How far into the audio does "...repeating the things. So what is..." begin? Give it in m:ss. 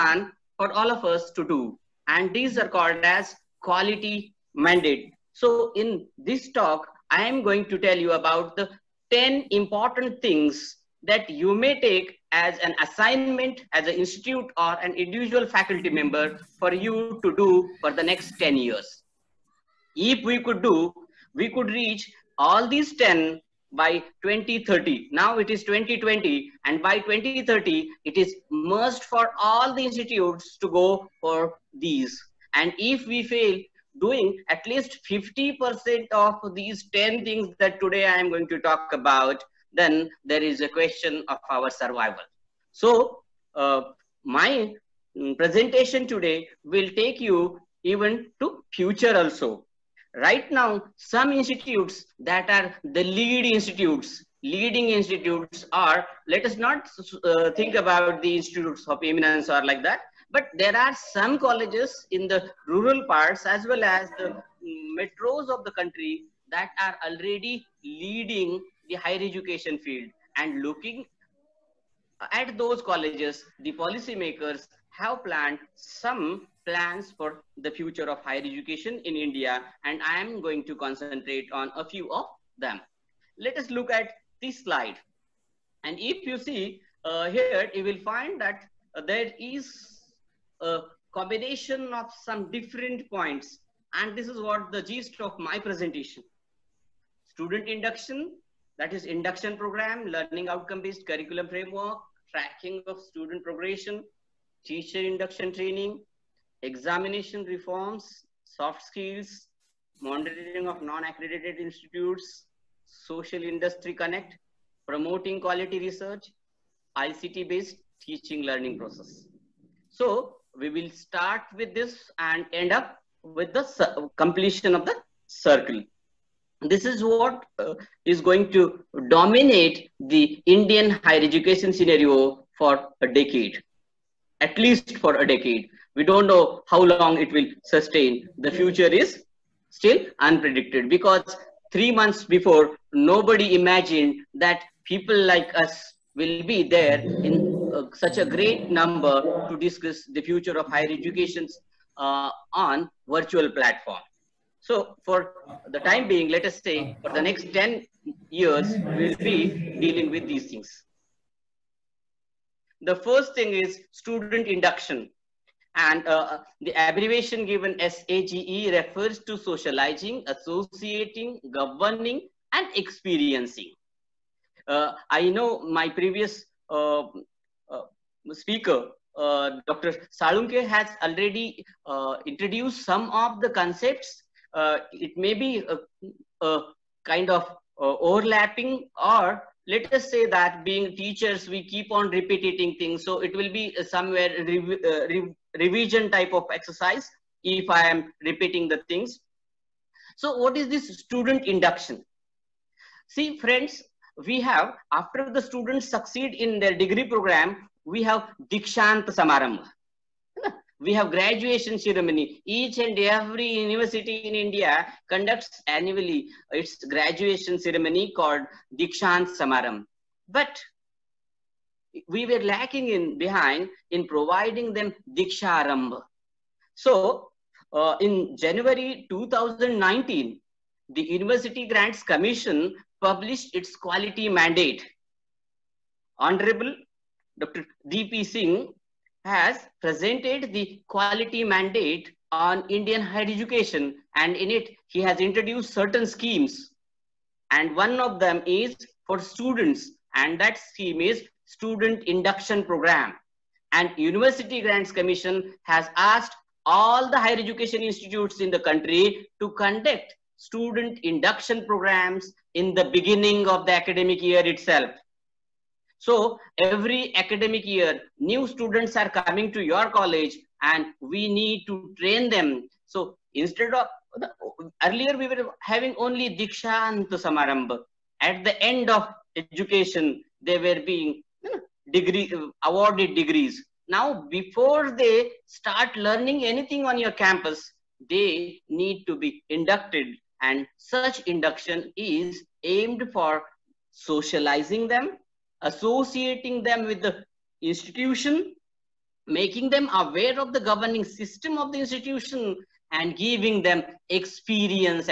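3:18.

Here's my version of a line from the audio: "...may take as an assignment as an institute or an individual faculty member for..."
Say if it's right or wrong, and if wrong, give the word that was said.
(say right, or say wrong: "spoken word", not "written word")
right.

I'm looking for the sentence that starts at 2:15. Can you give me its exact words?
We don't know how long it will sustain.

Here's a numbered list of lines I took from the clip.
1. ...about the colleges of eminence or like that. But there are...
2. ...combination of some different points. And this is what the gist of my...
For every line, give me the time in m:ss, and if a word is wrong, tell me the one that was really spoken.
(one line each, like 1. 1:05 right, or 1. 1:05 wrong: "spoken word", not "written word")
1. 0:57 wrong: "institutes", not "colleges"
2. 1:31 right.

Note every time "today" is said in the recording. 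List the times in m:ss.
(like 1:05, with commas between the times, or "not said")
0:37, 0:46.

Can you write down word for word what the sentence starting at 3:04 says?
it may be a, a kind of overlapping or let us say that being teachers, we keep on repeating things.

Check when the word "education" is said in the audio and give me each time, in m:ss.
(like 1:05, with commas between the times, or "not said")
1:09, 1:18, 2:11, 2:30, 4:03, 4:17, 4:39.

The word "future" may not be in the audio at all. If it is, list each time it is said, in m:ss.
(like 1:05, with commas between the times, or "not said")
0:48, 1:17, 2:18, 2:30.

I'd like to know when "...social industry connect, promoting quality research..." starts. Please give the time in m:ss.
1:52.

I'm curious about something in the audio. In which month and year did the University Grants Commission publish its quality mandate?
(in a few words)
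January 2019.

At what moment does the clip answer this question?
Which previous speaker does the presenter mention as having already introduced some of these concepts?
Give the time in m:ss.
2:59.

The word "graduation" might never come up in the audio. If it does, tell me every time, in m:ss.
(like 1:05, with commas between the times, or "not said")
3:31, 3:36.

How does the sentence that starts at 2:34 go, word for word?
So for the time being, let us say for the next 10 years, we'll be dealing with these things.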